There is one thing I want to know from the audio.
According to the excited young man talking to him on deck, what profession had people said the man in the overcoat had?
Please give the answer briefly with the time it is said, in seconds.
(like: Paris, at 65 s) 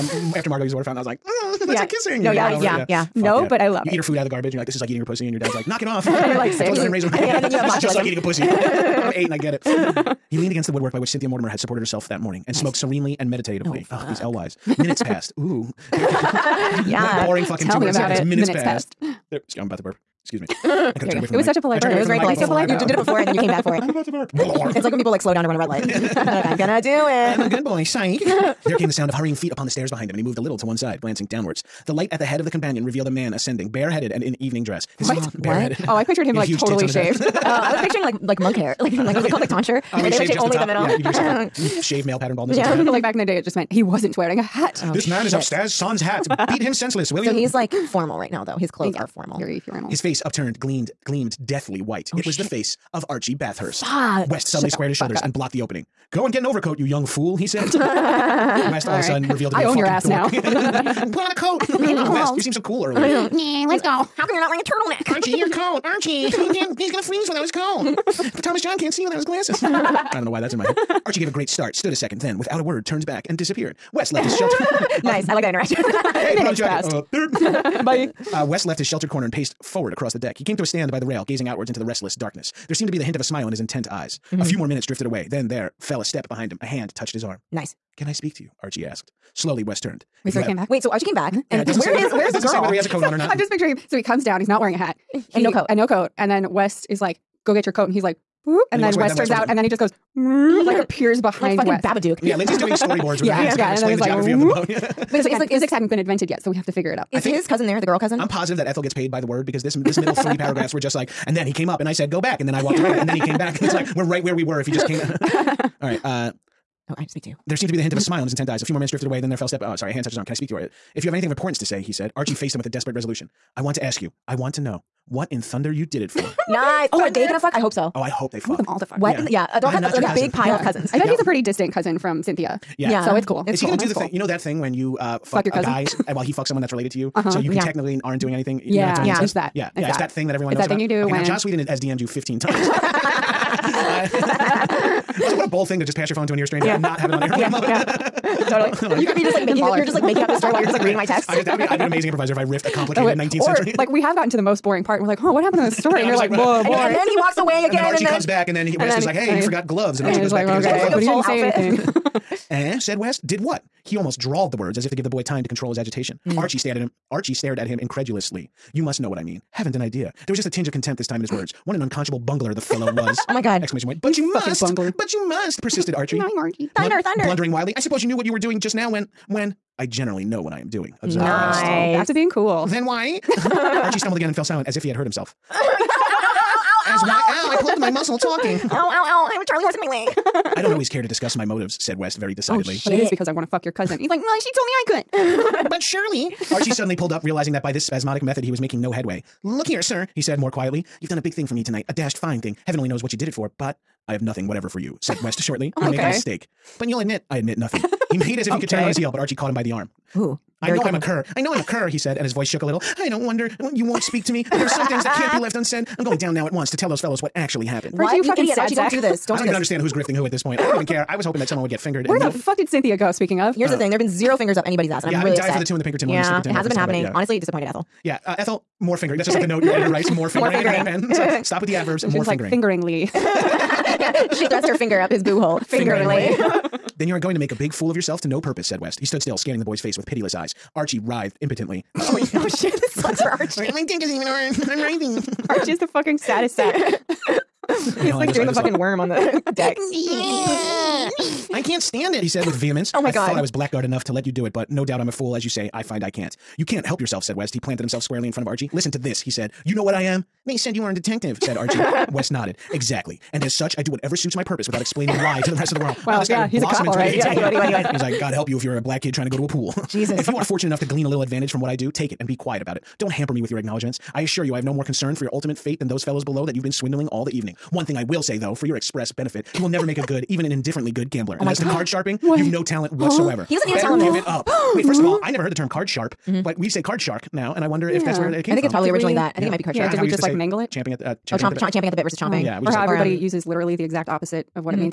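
detective, at 260 s.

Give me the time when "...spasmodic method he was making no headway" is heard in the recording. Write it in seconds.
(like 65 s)
197 s.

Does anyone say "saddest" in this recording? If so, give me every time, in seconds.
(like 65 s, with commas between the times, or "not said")
246 s.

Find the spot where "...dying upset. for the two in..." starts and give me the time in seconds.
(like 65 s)
225 s.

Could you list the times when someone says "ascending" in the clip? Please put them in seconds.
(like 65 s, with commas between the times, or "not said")
33 s.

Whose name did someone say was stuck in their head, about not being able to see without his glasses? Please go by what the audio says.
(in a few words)
Thomas John.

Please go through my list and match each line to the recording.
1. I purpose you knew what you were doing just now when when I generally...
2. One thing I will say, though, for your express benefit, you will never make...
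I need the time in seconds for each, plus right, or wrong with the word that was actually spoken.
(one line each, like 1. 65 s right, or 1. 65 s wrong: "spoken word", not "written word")
1. 177 s wrong: "suppose", not "purpose"
2. 277 s right.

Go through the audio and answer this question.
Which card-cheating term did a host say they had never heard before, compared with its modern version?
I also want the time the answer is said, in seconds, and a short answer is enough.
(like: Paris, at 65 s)
card sharp, at 285 s.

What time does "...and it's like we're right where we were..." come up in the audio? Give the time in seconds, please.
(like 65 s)
113 s.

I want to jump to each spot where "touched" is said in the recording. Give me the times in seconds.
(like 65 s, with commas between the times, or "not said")
86 s, 120 s.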